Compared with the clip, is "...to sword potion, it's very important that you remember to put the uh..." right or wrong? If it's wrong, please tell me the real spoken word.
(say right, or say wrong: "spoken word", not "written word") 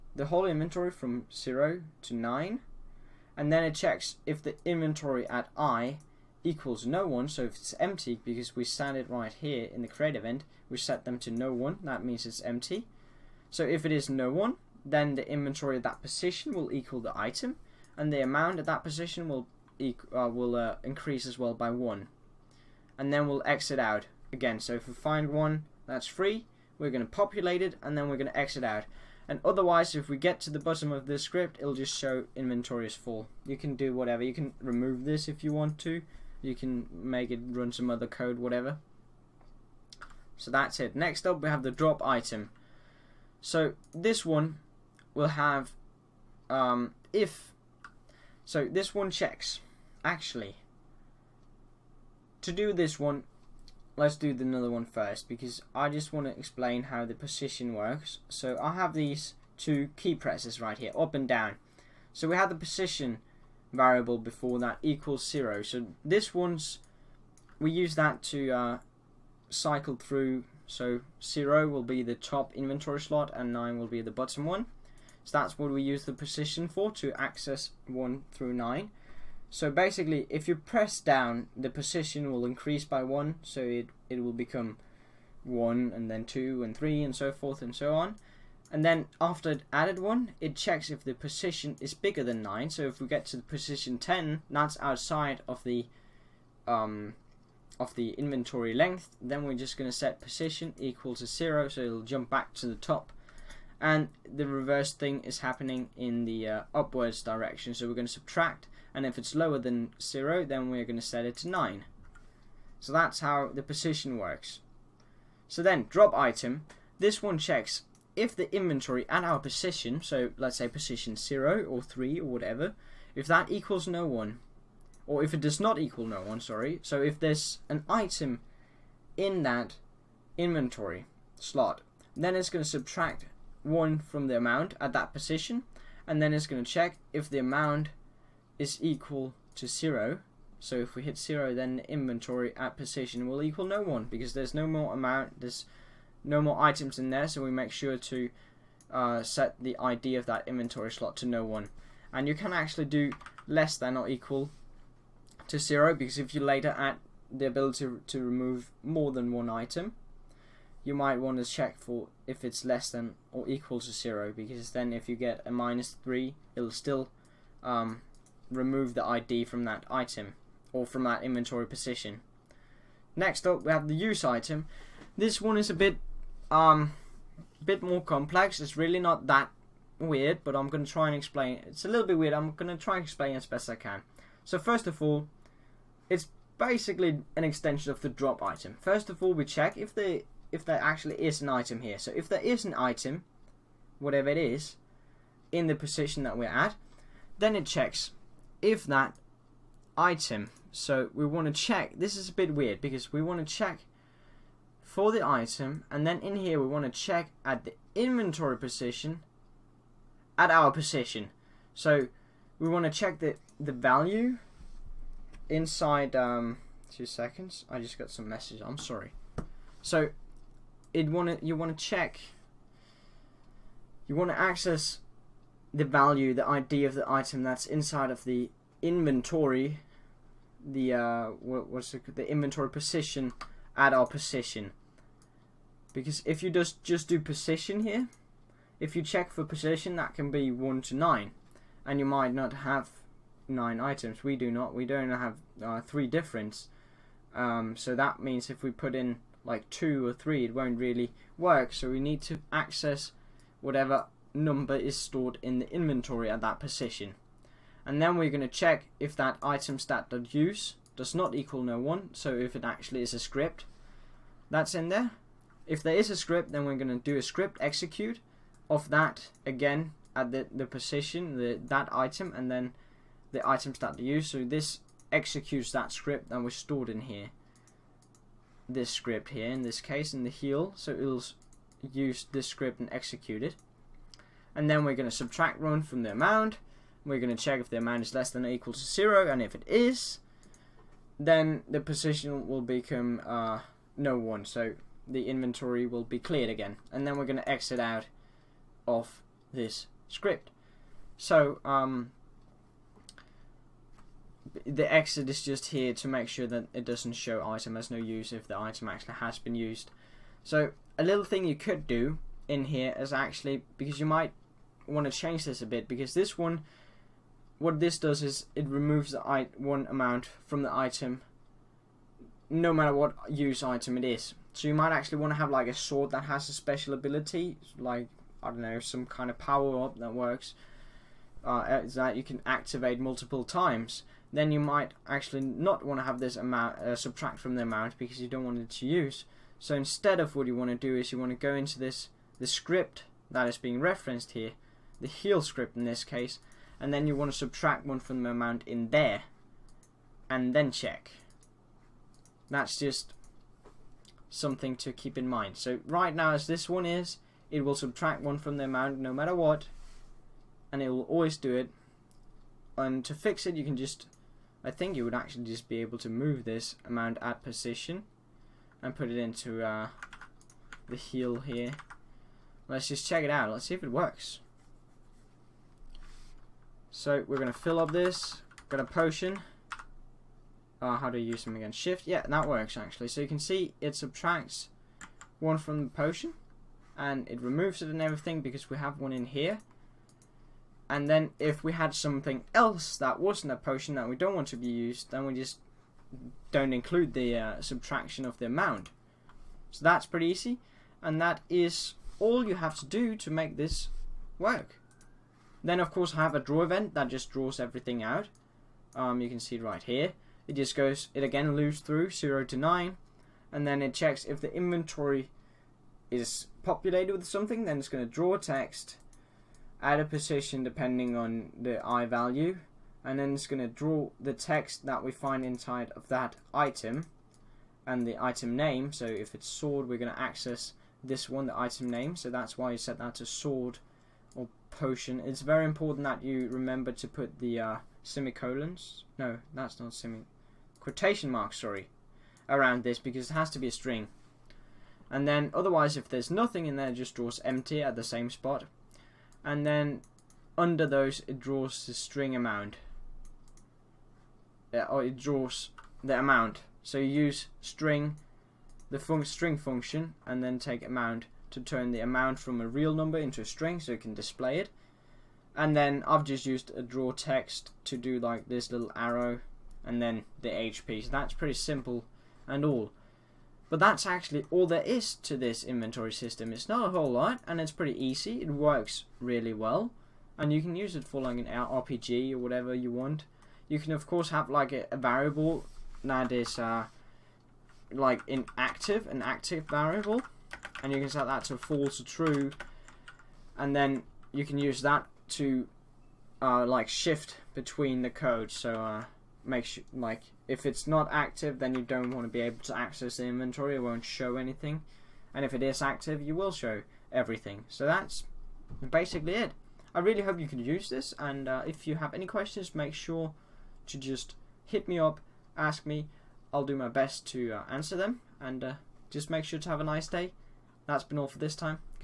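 right.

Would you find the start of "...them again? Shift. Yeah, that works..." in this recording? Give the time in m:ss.
6:21.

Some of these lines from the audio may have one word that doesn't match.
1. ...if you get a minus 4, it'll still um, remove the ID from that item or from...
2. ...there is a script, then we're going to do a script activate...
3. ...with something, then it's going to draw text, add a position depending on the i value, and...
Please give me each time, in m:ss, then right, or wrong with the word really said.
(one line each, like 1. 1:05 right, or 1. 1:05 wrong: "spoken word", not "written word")
1. 2:44 wrong: "3", not "4"
2. 4:25 wrong: "execute", not "activate"
3. 6:57 right.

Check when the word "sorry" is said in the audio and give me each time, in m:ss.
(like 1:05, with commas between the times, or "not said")
2:06, 3:38, 7:21.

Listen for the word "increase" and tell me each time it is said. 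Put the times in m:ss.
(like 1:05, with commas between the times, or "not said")
0:20, 1:22.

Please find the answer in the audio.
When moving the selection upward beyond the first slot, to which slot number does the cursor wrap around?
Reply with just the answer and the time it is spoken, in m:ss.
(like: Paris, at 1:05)
9, at 1:51.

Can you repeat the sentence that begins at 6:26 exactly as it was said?
And it removes it and everything because we have one in here.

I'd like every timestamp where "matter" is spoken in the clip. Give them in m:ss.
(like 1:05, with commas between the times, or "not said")
5:22, 5:59.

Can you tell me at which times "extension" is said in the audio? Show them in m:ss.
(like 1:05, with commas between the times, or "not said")
3:07.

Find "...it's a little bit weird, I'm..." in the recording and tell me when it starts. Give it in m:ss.
3:01.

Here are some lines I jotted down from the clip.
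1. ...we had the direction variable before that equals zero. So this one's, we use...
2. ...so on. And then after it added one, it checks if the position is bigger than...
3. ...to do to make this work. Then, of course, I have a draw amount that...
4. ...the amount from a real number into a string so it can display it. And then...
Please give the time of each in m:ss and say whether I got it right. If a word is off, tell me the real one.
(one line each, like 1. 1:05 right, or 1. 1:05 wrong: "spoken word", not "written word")
1. 1:02 wrong: "position", not "direction"
2. 1:27 right
3. 6:42 wrong: "event", not "amount"
4. 7:41 right.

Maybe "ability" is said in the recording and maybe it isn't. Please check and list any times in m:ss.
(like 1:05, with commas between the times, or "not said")
2:37, 5:26.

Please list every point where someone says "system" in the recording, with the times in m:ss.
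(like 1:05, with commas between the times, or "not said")
7:56.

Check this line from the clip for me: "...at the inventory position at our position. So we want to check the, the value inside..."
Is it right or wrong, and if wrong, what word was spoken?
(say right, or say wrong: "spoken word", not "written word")
right.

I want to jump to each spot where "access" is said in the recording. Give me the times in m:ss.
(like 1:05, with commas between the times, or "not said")
1:17, 3:44, 4:12, 7:10, 8:22.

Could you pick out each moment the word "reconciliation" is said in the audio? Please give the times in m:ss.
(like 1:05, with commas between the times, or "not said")
not said.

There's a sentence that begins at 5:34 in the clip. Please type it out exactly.
Then you might actually not want to have this amount, uh, subtract from the amount because you don't want it to use.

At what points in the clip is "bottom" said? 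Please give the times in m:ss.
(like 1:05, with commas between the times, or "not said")
0:30, 1:14.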